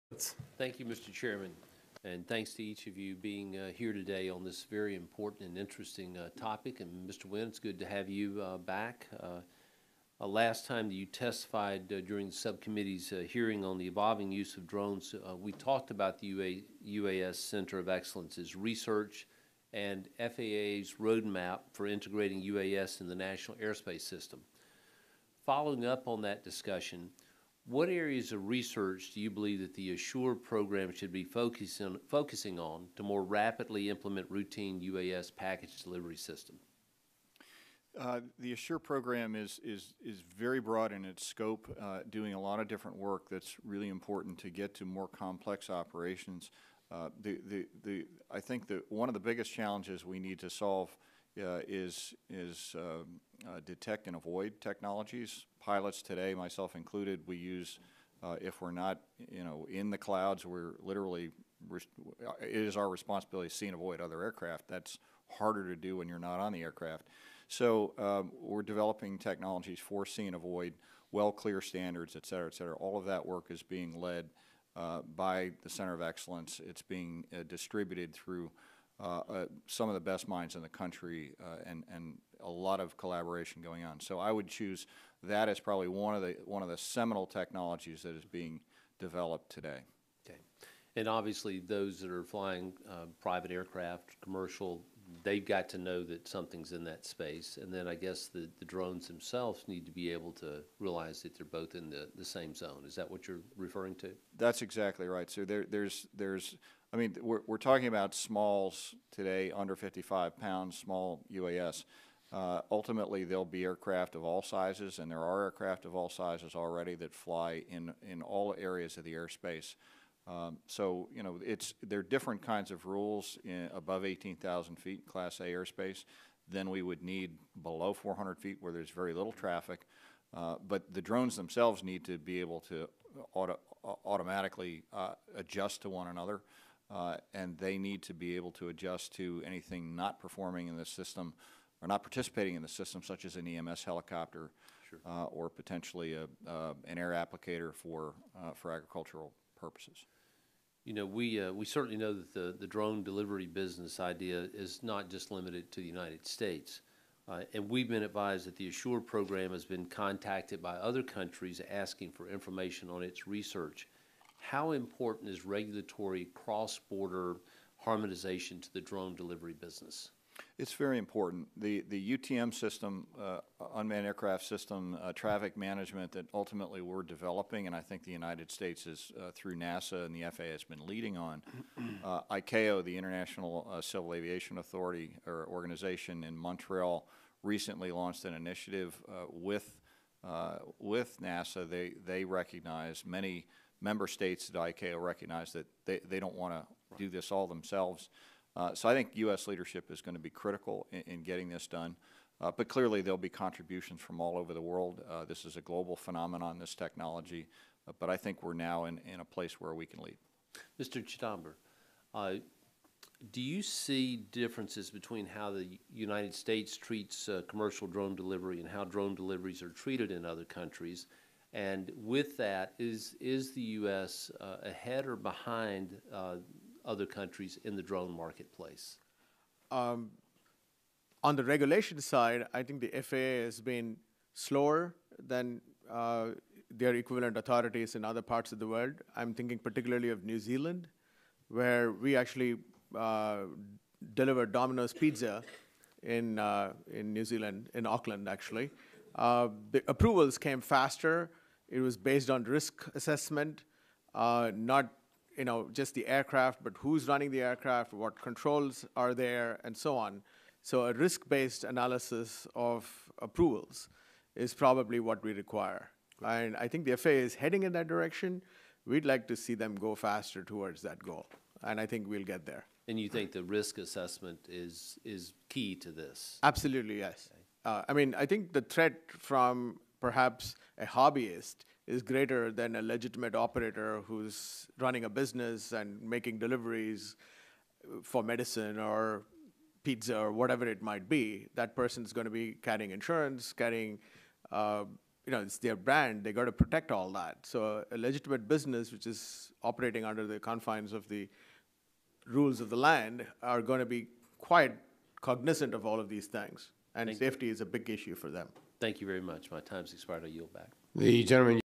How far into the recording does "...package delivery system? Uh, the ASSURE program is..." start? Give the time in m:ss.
0:35.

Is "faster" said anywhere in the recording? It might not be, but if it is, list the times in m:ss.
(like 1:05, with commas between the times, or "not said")
4:10, 4:29.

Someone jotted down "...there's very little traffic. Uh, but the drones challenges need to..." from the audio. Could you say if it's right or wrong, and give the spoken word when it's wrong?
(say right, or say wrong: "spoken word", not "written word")
wrong: "themselves", not "challenges".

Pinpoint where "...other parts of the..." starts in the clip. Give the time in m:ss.
3:58.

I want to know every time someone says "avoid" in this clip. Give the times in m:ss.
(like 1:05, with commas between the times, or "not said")
0:54, 1:03, 1:10.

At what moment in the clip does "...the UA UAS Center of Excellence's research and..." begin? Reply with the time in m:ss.
0:16.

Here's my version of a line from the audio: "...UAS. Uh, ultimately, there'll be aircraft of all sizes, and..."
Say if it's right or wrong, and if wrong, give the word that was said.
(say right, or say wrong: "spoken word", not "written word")
right.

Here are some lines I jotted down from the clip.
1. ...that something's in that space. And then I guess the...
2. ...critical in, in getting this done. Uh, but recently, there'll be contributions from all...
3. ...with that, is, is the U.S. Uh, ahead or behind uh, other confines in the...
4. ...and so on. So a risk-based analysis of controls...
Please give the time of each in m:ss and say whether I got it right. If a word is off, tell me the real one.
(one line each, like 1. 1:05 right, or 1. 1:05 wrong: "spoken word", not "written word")
1. 1:36 right
2. 3:20 wrong: "clearly", not "recently"
3. 3:41 wrong: "countries", not "confines"
4. 4:19 wrong: "approvals", not "controls".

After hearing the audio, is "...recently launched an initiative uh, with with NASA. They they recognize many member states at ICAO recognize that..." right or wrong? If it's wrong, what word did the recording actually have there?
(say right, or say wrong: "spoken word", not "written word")
right.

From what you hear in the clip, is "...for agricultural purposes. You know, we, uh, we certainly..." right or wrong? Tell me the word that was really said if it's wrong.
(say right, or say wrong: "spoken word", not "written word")
right.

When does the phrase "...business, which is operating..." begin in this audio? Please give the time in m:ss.
4:58.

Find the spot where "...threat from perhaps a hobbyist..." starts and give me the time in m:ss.
4:38.